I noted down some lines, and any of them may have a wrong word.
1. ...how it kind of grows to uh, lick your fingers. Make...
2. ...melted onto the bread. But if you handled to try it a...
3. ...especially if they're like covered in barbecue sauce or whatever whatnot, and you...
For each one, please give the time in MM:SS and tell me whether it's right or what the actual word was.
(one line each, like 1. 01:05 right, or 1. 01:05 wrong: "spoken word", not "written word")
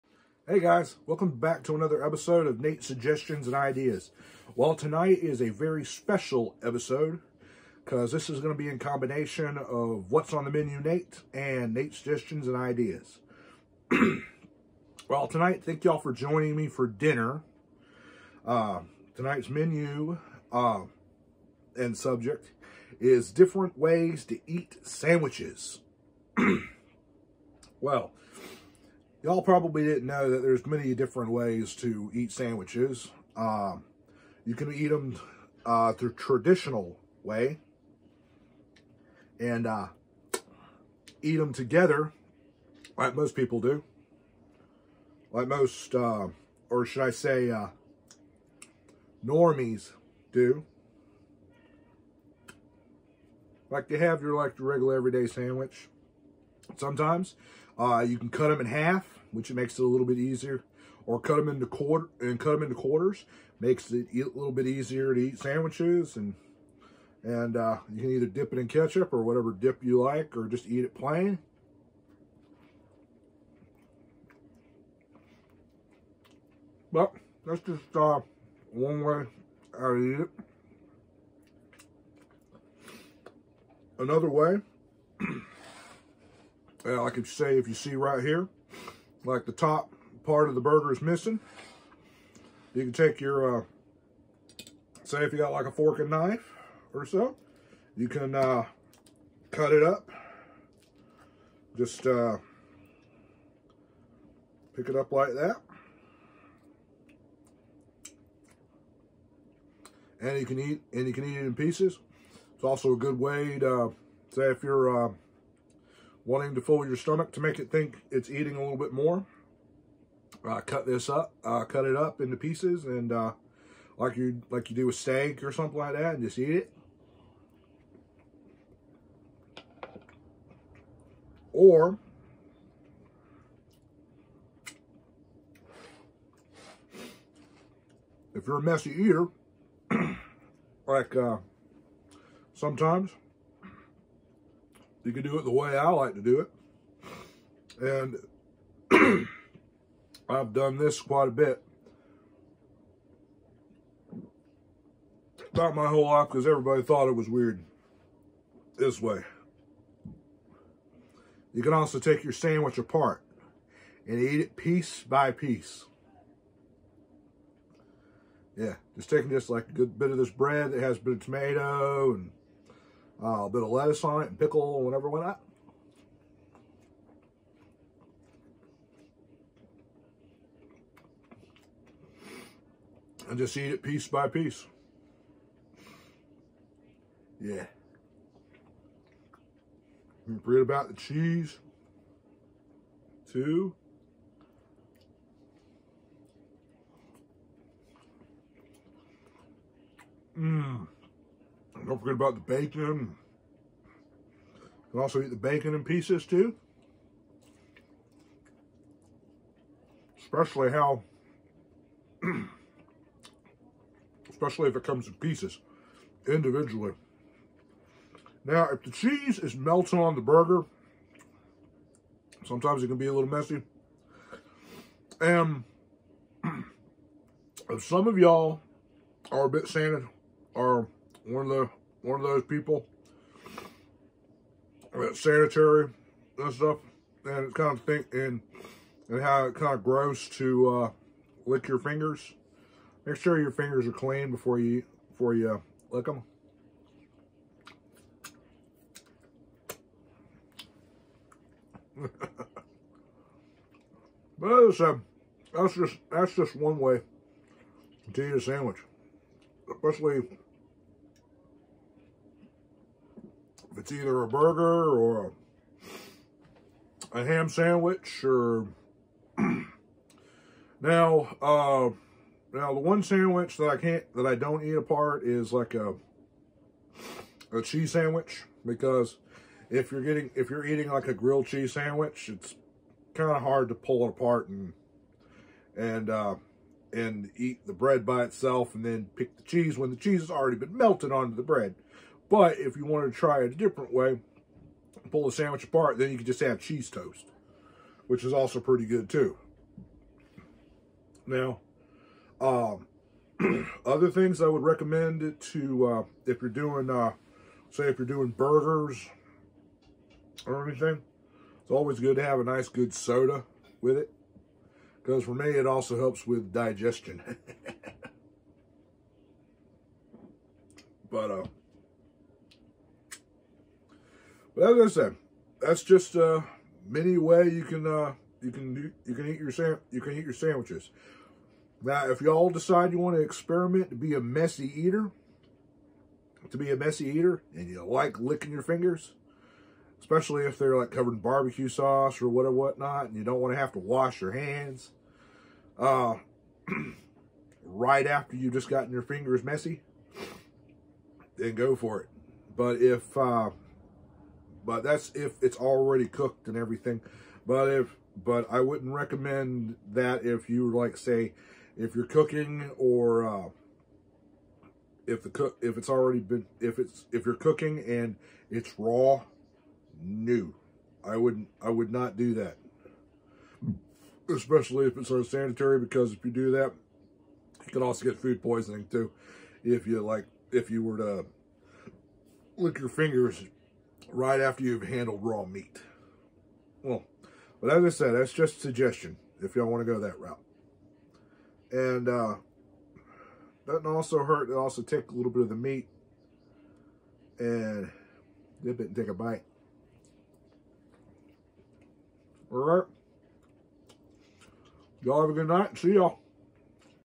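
1. 03:59 right
2. 04:50 wrong: "wanted", not "handled"
3. 05:39 right.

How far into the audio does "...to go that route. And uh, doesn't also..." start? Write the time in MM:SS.
06:29.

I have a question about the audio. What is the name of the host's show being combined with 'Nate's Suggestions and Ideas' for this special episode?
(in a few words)
What's on the Menu Nate.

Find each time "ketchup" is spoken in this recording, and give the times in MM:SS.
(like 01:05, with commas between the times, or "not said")
01:08.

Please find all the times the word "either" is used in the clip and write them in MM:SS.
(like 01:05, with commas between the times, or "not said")
01:08, 04:23.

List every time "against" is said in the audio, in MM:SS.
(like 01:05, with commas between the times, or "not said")
not said.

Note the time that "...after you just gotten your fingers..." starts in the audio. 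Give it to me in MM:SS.
05:48.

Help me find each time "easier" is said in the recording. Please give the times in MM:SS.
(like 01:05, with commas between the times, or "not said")
01:00, 01:04.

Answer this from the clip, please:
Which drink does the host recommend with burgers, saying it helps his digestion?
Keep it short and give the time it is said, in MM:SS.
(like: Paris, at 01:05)
soda, at 05:12.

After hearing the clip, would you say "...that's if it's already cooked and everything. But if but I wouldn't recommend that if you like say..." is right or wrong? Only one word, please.
right.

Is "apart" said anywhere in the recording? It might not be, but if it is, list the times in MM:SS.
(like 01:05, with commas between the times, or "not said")
02:42, 04:34, 04:44, 04:55.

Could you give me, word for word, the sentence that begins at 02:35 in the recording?
About my whole life because everybody thought it was weird this way.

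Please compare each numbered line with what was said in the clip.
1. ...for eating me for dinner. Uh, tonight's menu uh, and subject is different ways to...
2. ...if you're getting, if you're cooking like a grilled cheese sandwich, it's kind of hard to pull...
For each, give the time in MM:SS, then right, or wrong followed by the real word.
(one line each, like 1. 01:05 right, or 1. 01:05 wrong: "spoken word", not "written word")
1. 00:15 wrong: "joining", not "eating"
2. 04:39 wrong: "eating", not "cooking".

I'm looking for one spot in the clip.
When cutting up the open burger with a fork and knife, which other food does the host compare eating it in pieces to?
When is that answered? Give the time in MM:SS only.
02:04.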